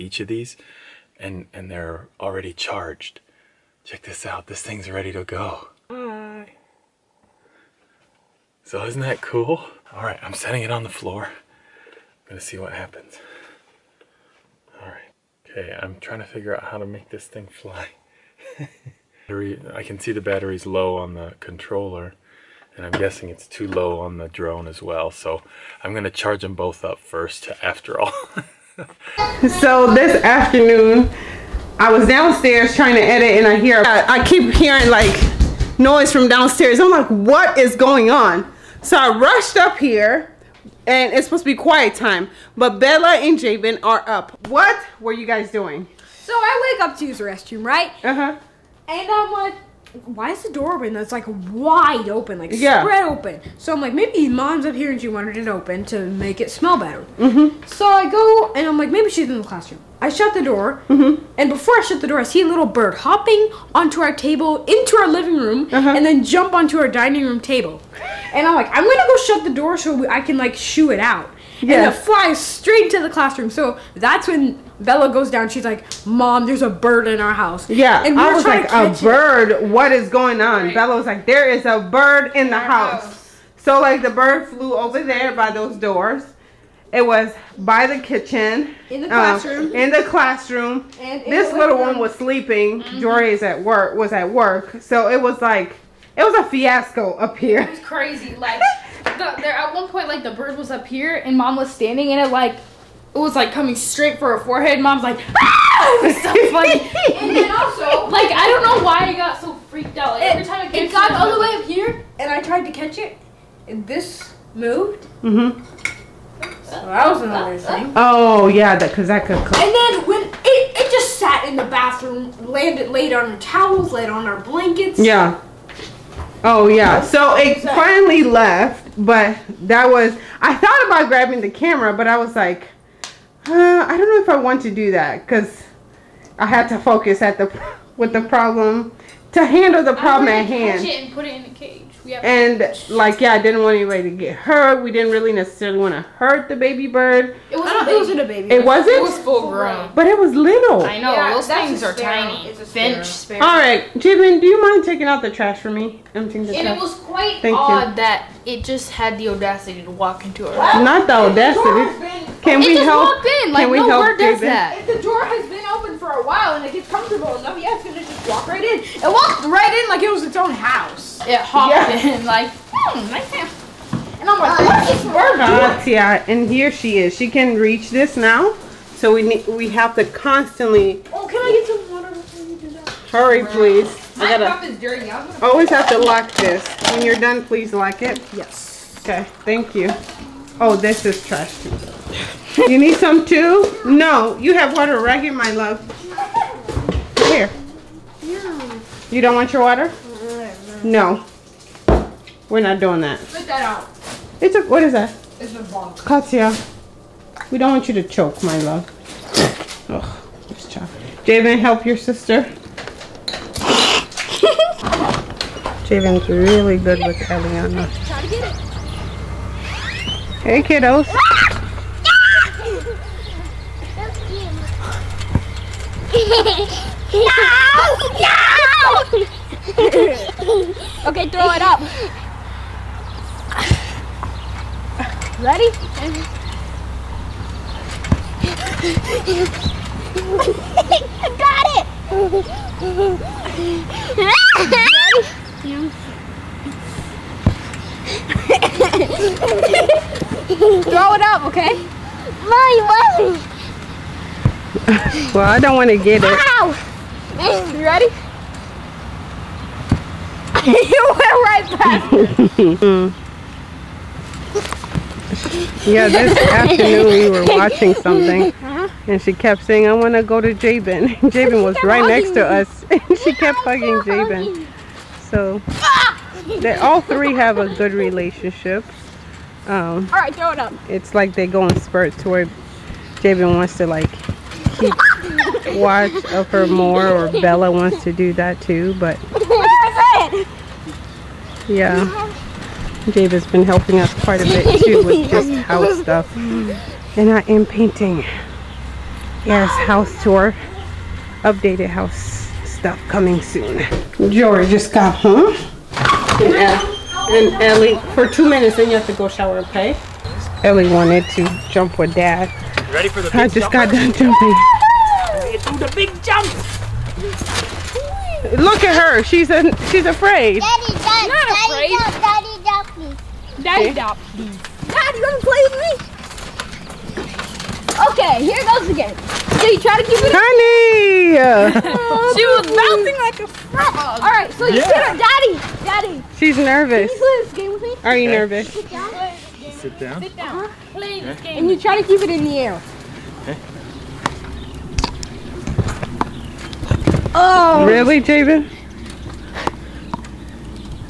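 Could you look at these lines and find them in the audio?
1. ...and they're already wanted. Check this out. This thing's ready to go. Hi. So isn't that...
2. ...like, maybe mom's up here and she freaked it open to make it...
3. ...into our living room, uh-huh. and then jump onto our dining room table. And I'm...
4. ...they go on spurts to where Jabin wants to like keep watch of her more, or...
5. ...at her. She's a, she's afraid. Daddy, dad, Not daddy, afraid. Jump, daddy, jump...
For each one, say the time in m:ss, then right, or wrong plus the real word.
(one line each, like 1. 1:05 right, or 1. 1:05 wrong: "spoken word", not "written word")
1. 0:01 wrong: "charged", not "wanted"
2. 0:53 wrong: "wanted", not "freaked"
3. 1:04 right
4. 4:41 right
5. 5:18 right.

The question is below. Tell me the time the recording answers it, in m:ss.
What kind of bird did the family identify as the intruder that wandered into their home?
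2:32.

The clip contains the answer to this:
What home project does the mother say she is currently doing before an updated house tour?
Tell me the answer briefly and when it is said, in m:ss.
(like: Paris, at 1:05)
painting, at 4:57.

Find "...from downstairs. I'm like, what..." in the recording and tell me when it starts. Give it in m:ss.
0:36.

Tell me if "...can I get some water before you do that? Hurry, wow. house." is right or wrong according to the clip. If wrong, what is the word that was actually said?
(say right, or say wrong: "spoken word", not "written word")
wrong: "please", not "house".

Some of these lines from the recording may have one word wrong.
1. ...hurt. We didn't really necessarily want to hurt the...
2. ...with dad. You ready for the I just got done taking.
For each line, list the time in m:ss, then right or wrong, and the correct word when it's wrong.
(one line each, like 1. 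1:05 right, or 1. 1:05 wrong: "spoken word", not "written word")
1. 2:24 right
2. 5:11 wrong: "jumping", not "taking".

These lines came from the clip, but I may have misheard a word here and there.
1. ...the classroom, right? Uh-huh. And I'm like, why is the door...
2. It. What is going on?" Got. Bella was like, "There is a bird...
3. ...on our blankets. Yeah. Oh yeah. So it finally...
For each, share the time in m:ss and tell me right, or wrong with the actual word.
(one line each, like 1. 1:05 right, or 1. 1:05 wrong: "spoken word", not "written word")
1. 0:47 wrong: "restroom", not "classroom"
2. 1:19 wrong: "Right", not "Got"
3. 2:04 right.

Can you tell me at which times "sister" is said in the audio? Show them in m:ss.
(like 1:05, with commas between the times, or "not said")
3:31.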